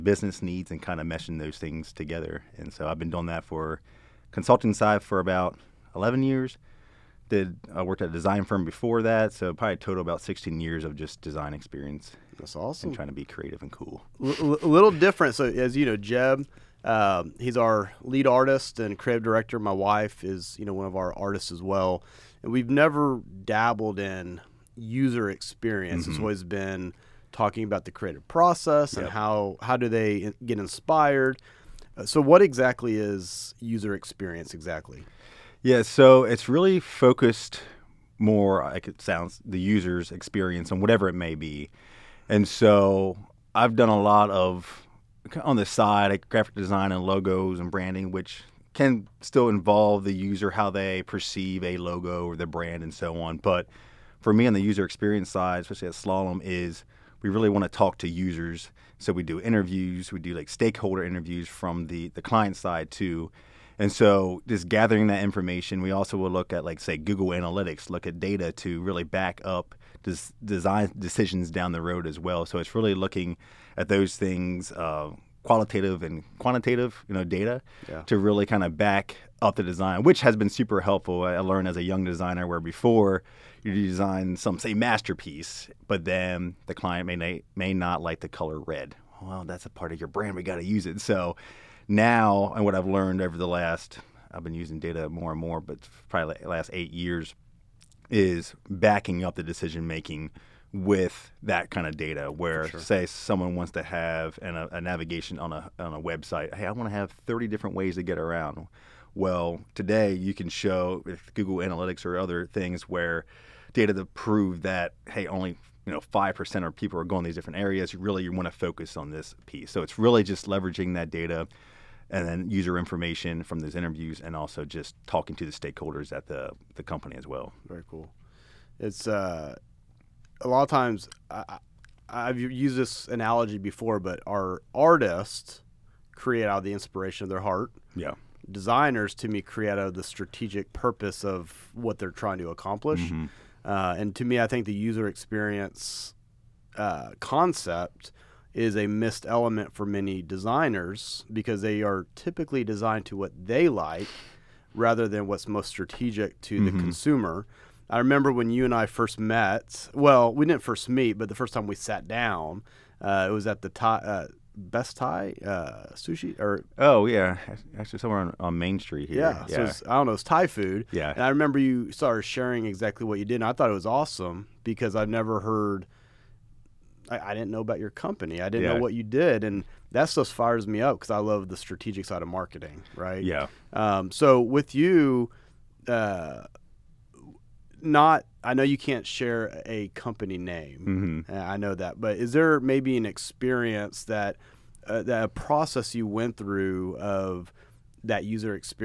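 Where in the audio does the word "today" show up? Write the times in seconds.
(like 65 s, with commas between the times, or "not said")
109 s.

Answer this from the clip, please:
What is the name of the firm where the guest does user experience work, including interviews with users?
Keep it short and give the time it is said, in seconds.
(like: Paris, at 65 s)
Slalom, at 55 s.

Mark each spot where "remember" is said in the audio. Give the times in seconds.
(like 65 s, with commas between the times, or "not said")
157 s, 171 s.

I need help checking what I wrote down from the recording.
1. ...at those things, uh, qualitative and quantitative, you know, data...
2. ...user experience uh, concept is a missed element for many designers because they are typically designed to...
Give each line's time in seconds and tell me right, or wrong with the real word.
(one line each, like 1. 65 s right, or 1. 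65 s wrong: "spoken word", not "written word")
1. 73 s right
2. 144 s right.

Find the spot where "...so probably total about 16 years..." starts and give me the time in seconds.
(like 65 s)
9 s.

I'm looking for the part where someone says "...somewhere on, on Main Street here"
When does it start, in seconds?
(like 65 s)
167 s.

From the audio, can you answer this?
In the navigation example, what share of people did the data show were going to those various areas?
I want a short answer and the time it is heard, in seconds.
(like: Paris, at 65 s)
5%, at 116 s.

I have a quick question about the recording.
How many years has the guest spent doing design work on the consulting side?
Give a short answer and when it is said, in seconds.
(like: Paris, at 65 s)
11 years, at 5 s.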